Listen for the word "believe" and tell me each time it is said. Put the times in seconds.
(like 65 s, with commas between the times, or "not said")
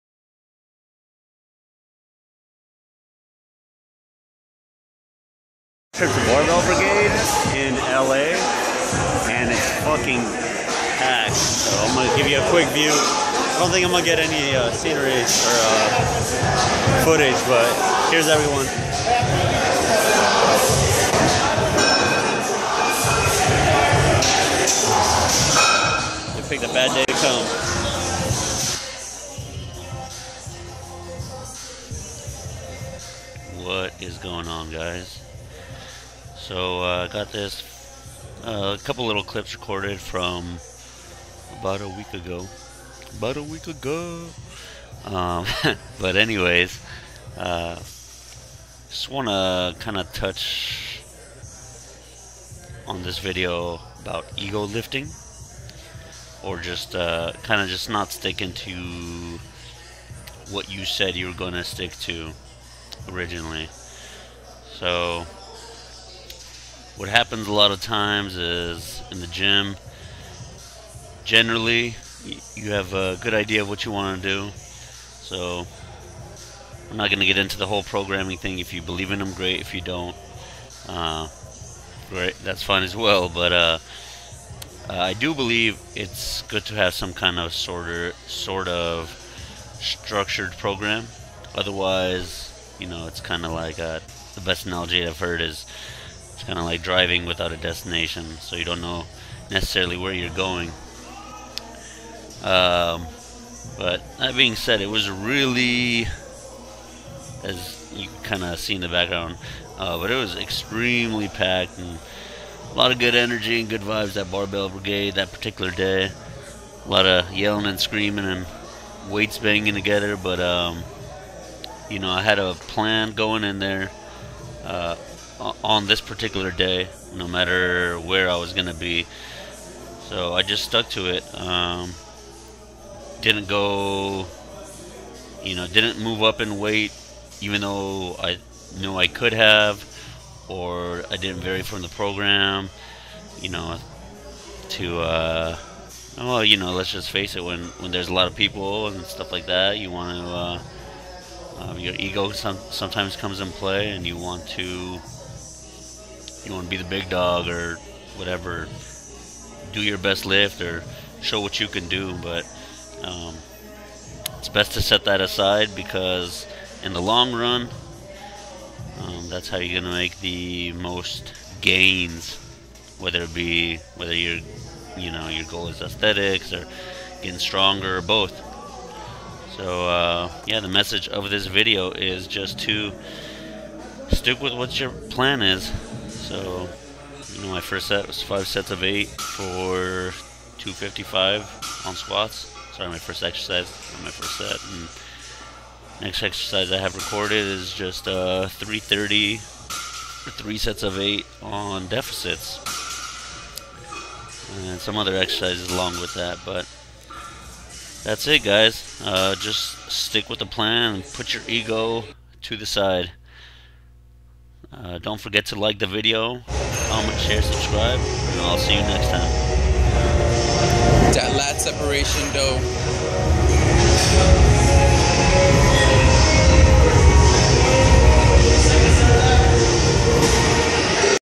78 s, 85 s.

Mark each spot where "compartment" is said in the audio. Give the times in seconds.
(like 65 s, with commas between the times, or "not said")
not said.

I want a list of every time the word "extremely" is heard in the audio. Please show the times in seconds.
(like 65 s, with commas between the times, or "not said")
110 s.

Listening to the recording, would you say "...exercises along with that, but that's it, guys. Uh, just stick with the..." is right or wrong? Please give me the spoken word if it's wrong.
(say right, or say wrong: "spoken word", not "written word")
right.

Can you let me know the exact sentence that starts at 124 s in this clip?
Uh, on this particular day, no matter where I was gonna be.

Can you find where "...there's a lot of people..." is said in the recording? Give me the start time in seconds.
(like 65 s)
147 s.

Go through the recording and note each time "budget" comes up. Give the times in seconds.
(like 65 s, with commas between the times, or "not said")
not said.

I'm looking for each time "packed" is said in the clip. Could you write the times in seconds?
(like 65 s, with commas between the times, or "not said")
10 s, 111 s.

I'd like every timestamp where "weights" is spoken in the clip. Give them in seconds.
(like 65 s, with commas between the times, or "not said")
119 s, 136 s.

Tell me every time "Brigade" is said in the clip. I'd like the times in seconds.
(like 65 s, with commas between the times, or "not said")
6 s, 114 s.